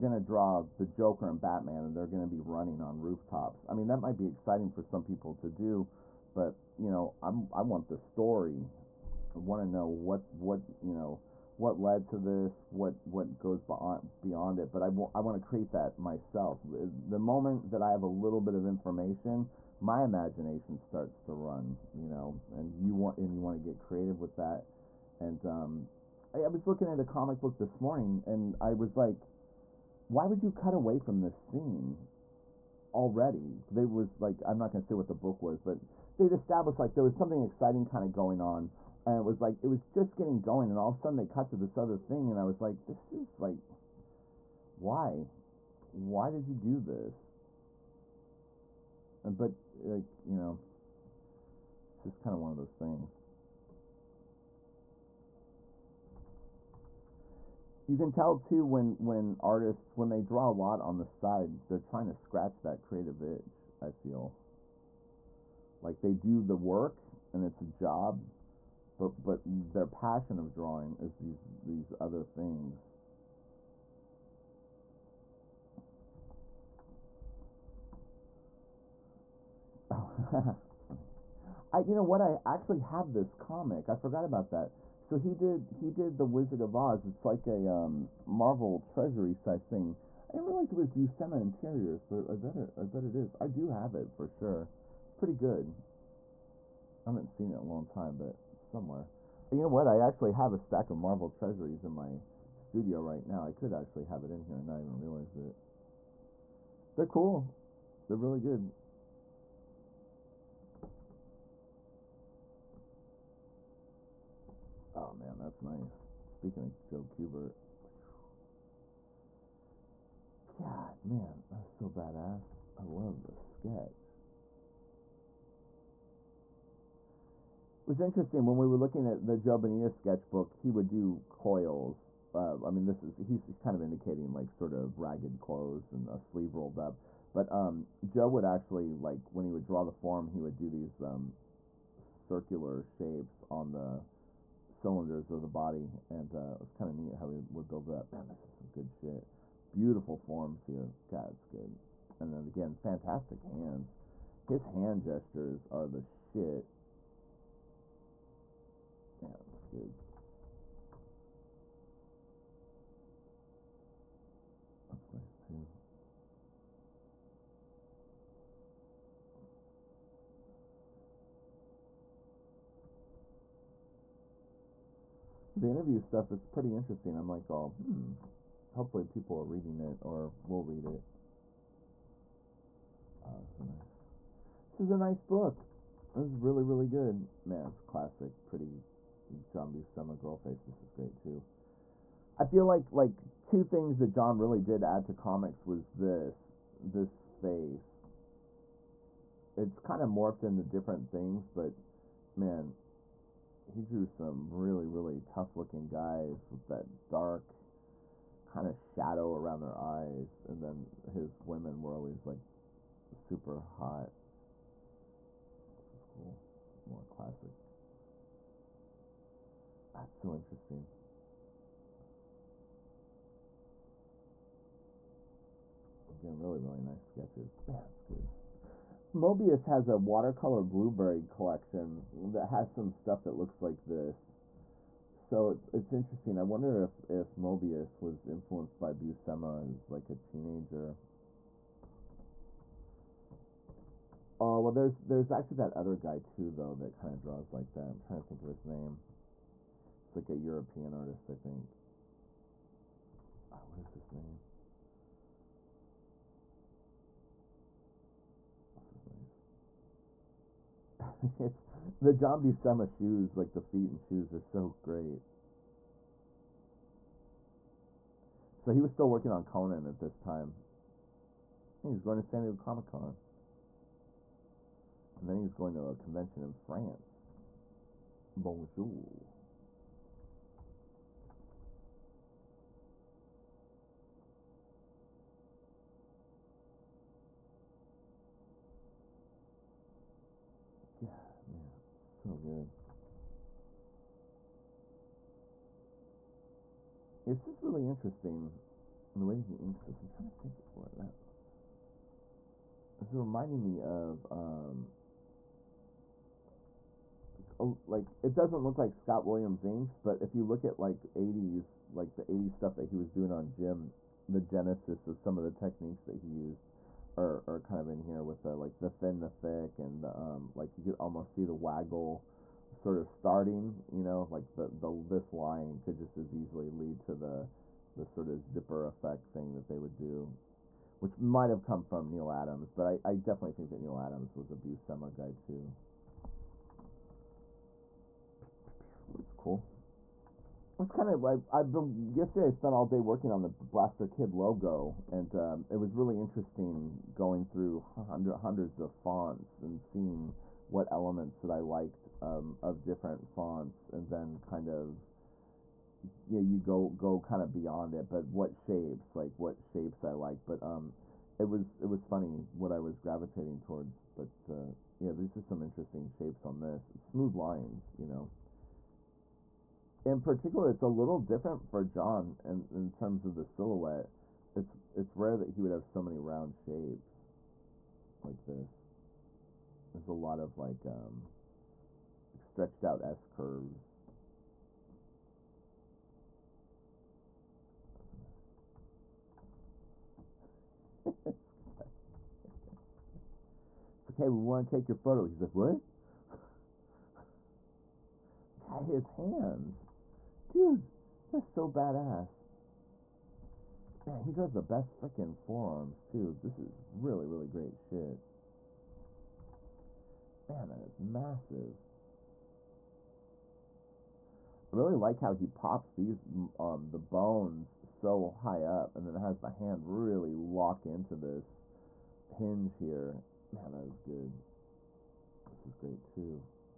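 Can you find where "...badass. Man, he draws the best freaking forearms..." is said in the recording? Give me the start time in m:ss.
6:41.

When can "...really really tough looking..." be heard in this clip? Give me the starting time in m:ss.
3:24.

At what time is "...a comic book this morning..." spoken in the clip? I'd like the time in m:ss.
0:26.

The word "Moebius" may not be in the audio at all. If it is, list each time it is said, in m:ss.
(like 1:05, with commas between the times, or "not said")
3:49, 3:57.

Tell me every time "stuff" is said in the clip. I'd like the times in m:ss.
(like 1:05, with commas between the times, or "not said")
2:56, 3:52, 5:12.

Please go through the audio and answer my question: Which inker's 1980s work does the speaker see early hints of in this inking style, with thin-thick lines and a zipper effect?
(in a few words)
Scott Williams.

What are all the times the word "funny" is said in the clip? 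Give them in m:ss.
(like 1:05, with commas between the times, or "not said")
1:20, 6:02.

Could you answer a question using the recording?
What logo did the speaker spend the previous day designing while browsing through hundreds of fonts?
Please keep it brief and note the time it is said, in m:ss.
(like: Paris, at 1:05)
Blasterkid, at 5:43.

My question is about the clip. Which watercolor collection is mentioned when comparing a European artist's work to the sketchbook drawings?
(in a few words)
Blueberry.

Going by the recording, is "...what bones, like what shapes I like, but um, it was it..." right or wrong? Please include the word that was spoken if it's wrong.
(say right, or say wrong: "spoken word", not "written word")
wrong: "shapes", not "bones".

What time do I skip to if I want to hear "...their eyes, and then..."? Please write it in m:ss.
3:29.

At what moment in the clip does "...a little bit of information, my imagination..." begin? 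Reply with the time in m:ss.
0:18.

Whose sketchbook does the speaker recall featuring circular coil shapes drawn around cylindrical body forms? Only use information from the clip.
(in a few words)
Joe Bonilla.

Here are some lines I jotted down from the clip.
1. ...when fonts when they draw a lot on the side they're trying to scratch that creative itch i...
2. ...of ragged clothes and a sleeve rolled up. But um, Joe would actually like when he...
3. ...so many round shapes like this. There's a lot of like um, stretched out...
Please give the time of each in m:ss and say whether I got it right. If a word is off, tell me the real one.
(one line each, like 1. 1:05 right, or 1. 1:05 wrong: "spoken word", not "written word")
1. 0:58 wrong: "artists", not "fonts"
2. 2:14 right
3. 6:15 right.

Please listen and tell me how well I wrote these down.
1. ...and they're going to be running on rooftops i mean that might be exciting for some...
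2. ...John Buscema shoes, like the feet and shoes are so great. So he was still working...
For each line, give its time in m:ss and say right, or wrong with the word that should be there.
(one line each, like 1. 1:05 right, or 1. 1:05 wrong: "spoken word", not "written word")
1. 0:01 right
2. 4:22 right.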